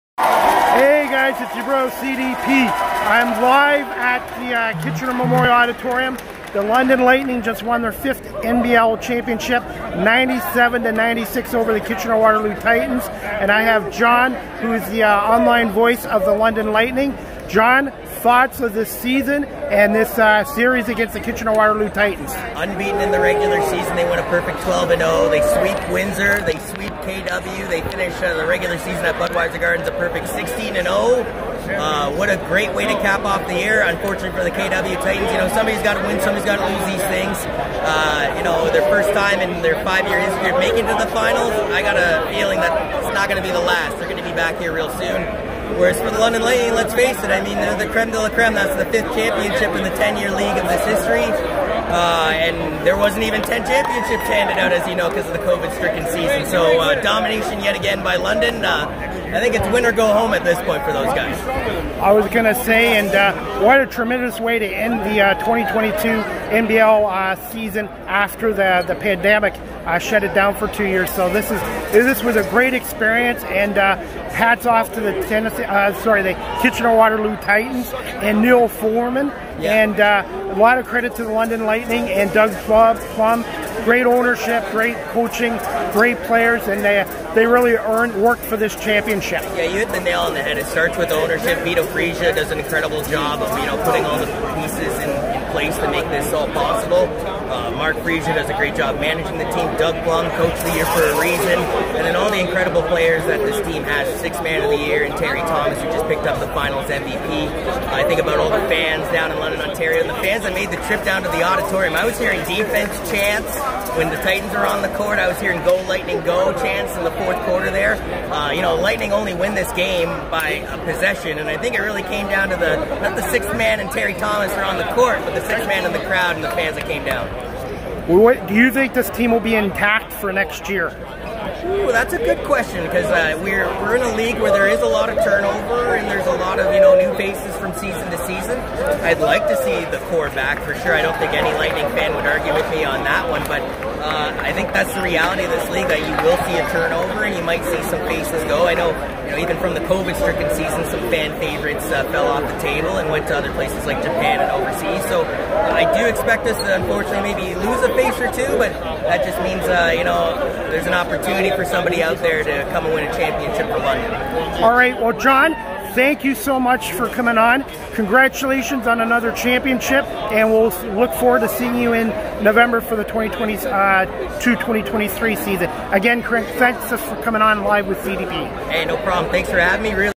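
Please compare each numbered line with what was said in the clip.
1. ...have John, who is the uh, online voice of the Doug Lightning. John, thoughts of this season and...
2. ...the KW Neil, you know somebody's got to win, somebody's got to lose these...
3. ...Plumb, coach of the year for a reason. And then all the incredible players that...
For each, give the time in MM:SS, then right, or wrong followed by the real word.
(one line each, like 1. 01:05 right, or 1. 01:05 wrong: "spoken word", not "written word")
1. 00:13 wrong: "London", not "Doug"
2. 00:34 wrong: "Titans", not "Neil"
3. 01:40 right.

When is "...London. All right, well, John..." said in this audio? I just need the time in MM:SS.
02:43.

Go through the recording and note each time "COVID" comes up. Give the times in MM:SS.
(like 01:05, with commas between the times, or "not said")
00:55, 02:29.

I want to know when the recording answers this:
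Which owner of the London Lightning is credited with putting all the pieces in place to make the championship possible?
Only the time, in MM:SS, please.
01:31.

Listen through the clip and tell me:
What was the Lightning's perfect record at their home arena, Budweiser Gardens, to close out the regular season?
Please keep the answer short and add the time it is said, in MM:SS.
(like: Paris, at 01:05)
16 and 0, at 00:30.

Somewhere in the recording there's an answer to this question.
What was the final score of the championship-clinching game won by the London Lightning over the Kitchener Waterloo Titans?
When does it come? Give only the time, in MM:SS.
00:09.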